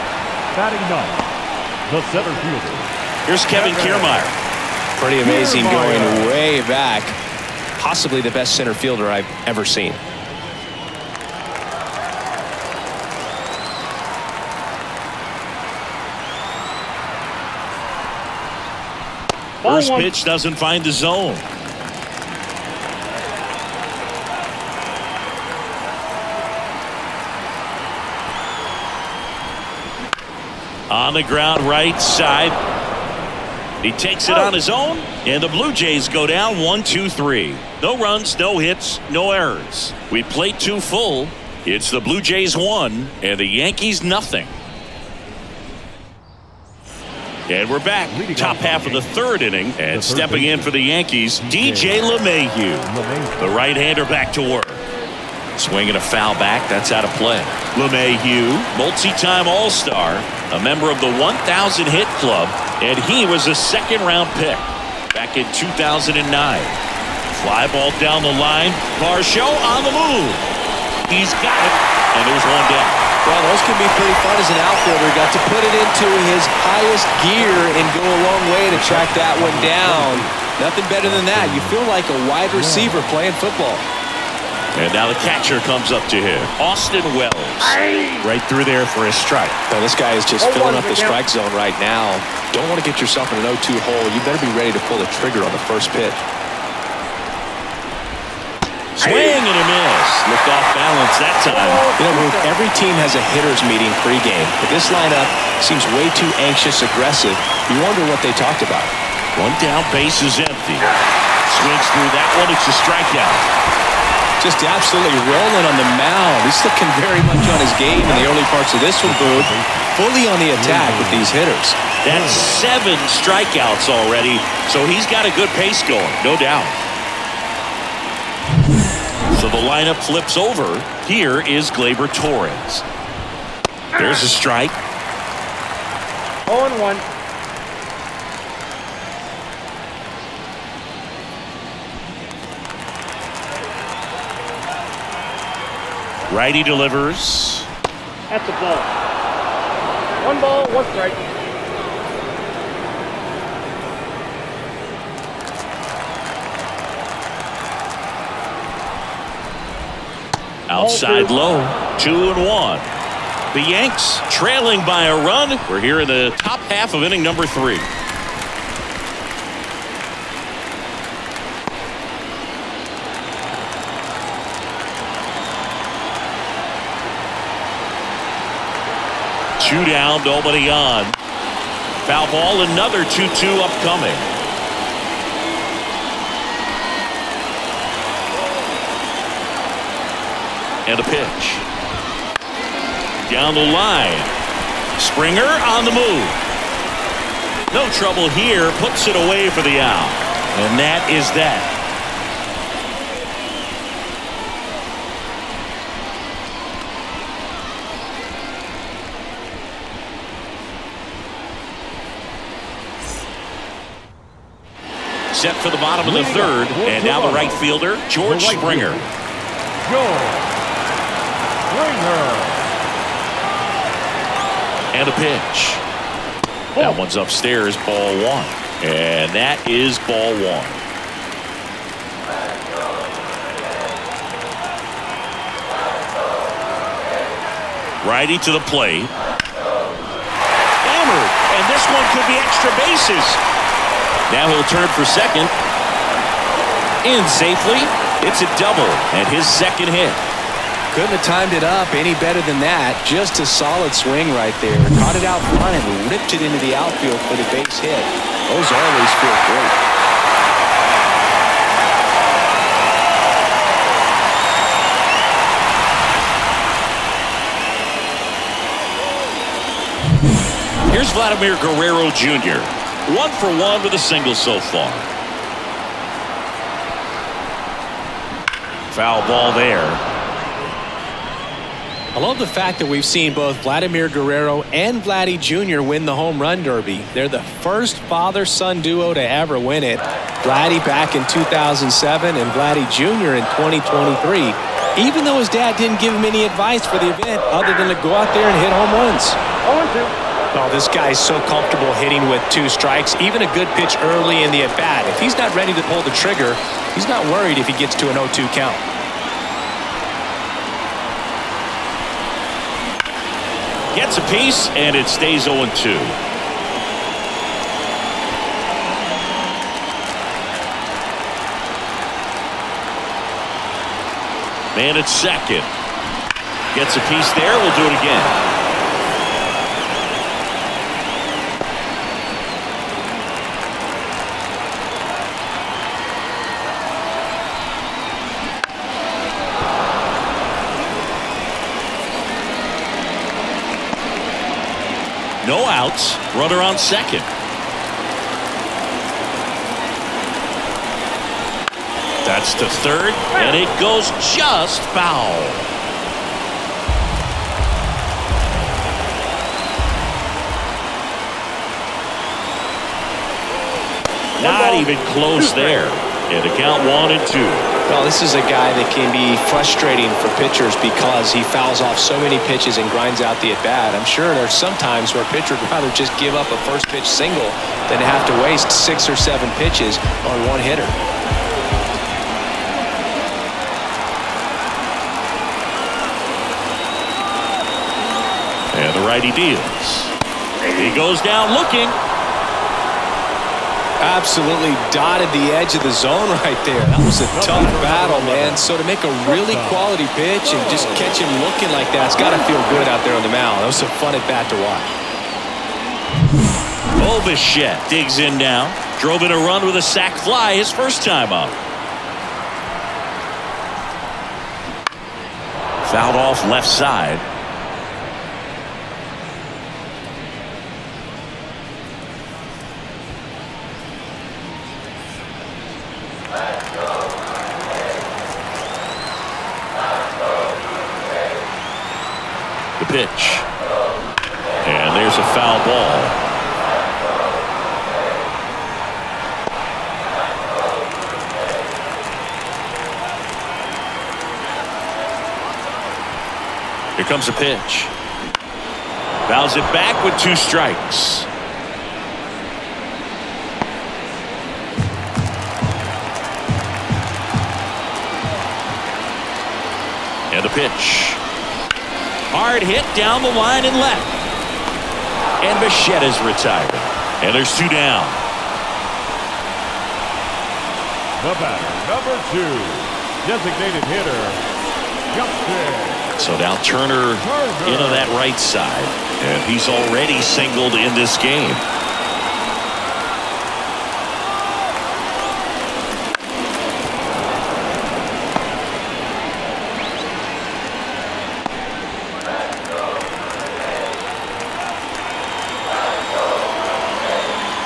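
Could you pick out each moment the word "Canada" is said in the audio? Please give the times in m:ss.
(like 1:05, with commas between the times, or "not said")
not said.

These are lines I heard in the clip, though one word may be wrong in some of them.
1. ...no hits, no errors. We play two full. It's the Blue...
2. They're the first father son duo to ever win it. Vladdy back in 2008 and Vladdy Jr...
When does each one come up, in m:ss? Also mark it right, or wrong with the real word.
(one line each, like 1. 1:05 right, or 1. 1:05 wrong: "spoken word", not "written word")
1. 0:38 right
2. 4:47 wrong: "2007", not "2008".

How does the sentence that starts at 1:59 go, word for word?
Fully on the attack with these hitters.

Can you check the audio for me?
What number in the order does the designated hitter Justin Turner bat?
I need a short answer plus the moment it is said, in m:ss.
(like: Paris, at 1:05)
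2, at 7:51.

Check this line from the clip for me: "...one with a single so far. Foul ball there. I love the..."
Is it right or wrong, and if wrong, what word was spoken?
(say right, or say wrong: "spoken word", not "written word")
right.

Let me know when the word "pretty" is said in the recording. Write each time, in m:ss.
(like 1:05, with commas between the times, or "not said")
0:04, 1:13.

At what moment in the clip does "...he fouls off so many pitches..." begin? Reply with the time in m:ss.
6:11.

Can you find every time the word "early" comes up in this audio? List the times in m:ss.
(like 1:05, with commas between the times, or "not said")
1:58, 5:04.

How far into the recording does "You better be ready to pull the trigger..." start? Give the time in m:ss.
1:34.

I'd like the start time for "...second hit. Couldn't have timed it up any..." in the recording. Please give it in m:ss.
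4:09.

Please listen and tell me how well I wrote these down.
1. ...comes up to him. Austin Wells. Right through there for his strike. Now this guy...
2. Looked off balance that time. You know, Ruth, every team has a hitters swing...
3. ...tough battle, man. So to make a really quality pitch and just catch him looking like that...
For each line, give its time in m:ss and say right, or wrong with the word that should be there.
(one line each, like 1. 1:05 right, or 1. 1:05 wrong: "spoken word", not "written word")
1. 1:25 right
2. 1:40 wrong: "meeting", not "swing"
3. 6:37 right.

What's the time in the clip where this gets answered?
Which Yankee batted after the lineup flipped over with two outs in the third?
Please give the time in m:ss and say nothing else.
2:11.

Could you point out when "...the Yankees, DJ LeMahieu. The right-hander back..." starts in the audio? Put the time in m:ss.
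0:50.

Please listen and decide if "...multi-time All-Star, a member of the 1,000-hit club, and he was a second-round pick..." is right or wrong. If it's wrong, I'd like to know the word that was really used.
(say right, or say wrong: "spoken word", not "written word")
right.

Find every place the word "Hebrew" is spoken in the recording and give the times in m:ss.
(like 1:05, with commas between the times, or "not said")
not said.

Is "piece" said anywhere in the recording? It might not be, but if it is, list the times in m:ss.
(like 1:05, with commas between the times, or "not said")
5:14, 5:27.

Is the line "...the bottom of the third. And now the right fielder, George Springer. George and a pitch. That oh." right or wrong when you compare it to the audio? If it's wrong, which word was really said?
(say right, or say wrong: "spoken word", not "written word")
right.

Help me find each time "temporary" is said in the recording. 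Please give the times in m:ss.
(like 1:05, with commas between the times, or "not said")
not said.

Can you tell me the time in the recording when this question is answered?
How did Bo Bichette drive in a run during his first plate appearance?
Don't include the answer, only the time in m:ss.
6:49.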